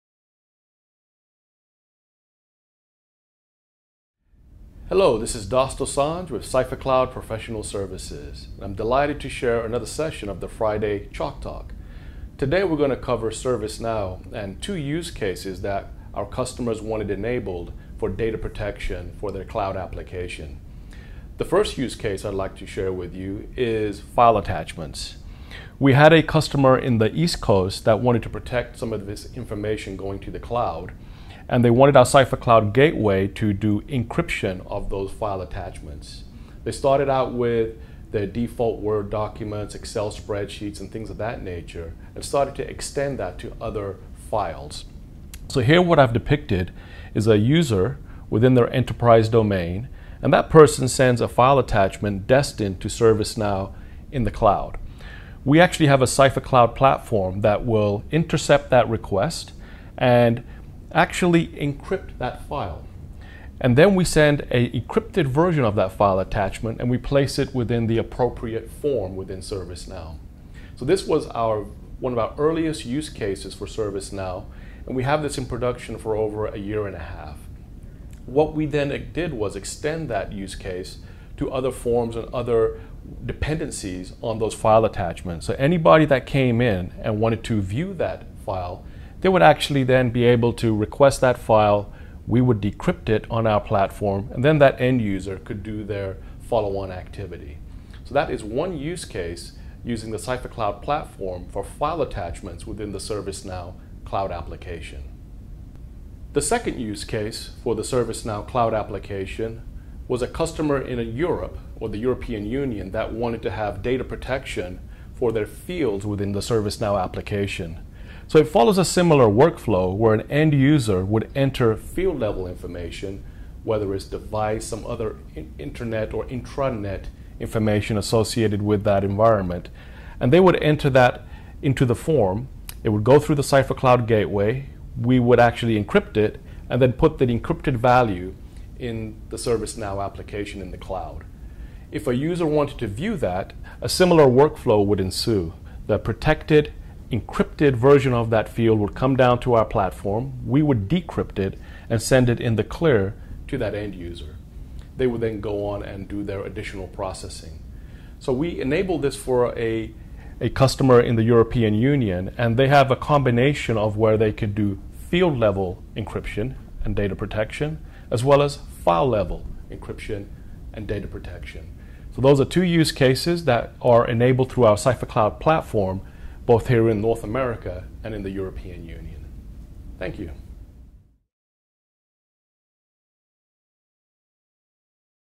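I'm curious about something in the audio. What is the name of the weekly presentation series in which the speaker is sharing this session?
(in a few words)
Friday Chalk Talk.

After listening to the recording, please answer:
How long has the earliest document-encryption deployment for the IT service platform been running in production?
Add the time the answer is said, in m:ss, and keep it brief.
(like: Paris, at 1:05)
Over a year and a half, at 1:16.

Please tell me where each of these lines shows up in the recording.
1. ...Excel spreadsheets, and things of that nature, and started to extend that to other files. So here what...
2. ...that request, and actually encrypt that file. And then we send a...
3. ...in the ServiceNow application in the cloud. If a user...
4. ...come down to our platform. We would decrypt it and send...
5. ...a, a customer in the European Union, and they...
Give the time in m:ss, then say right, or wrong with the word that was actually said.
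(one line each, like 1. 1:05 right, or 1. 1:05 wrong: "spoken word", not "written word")
1. 0:39 right
2. 0:58 right
3. 2:18 right
4. 2:28 right
5. 2:39 right.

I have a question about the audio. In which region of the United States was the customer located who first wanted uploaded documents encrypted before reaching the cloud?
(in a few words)
East Coast.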